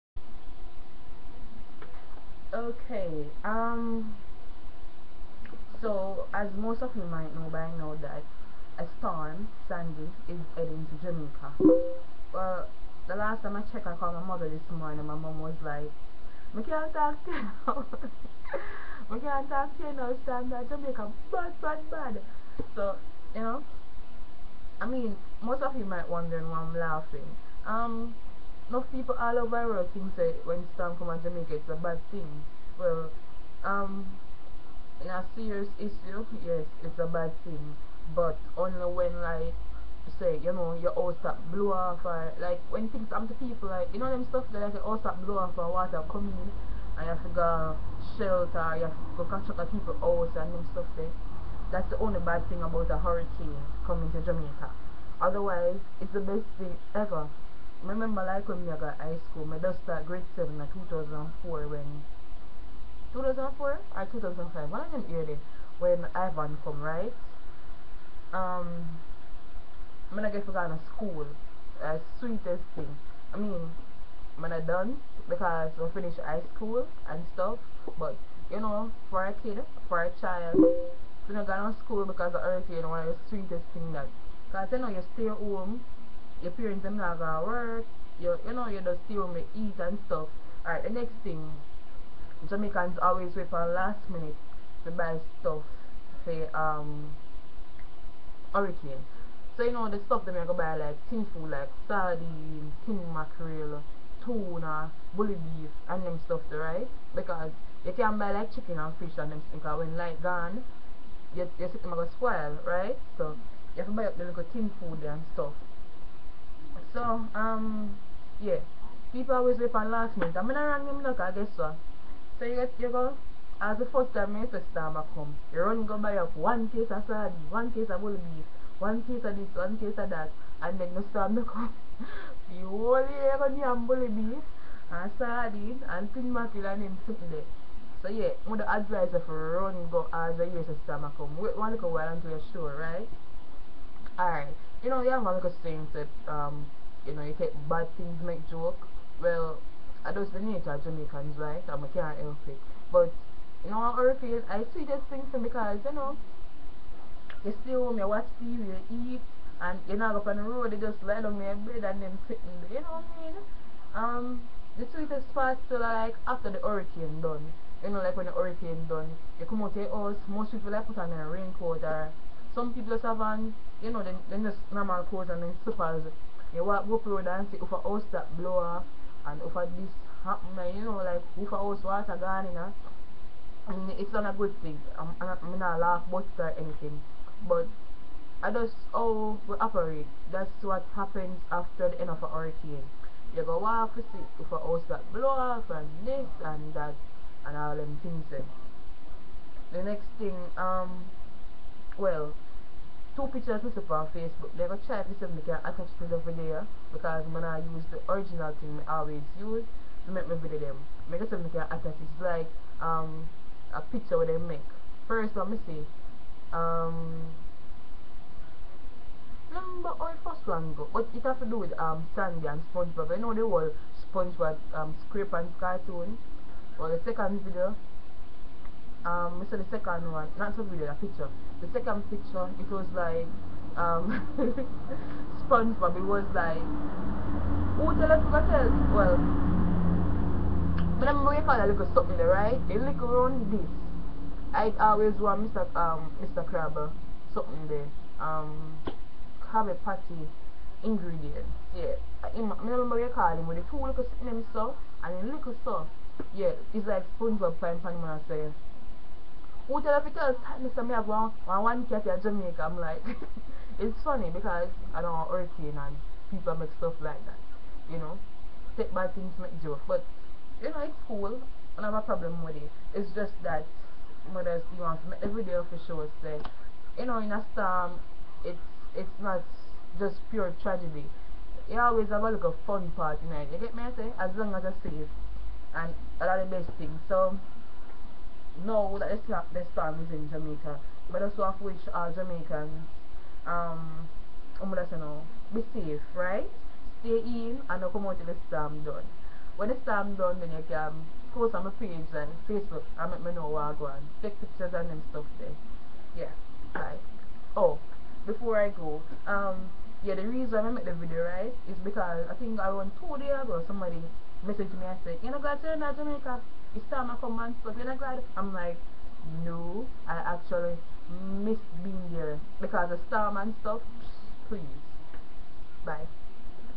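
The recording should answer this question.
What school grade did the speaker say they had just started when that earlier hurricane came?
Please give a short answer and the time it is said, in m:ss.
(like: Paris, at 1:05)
Grade 7, at 1:00.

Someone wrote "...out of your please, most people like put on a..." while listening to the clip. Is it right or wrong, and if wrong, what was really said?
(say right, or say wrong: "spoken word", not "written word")
wrong: "house", not "please".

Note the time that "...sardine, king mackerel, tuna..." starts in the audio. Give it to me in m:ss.
1:41.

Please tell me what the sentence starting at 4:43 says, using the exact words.
I say, as long as I save, and a lot of best things.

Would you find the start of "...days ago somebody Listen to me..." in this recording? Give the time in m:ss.
5:13.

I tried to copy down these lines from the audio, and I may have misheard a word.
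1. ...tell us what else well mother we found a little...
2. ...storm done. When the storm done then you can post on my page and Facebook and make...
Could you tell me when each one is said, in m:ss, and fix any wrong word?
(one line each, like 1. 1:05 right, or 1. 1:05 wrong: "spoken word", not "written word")
1. 3:57 wrong: "remember", not "mother"
2. 4:58 right.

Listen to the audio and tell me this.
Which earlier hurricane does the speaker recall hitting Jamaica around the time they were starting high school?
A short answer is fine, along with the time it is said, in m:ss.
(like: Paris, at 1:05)
Ivan, at 1:06.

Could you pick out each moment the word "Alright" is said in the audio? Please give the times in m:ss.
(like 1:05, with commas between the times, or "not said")
1:30, 2:24.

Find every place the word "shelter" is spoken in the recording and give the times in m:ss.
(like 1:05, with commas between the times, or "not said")
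0:48.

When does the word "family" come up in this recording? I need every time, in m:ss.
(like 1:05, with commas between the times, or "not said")
not said.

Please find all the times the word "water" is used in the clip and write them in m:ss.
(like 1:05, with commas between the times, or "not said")
0:45, 3:01.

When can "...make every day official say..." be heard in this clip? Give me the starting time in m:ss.
4:35.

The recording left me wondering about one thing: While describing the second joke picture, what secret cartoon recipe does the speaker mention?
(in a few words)
Krabby Patty ingredients.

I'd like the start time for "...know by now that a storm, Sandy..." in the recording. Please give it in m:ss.
0:07.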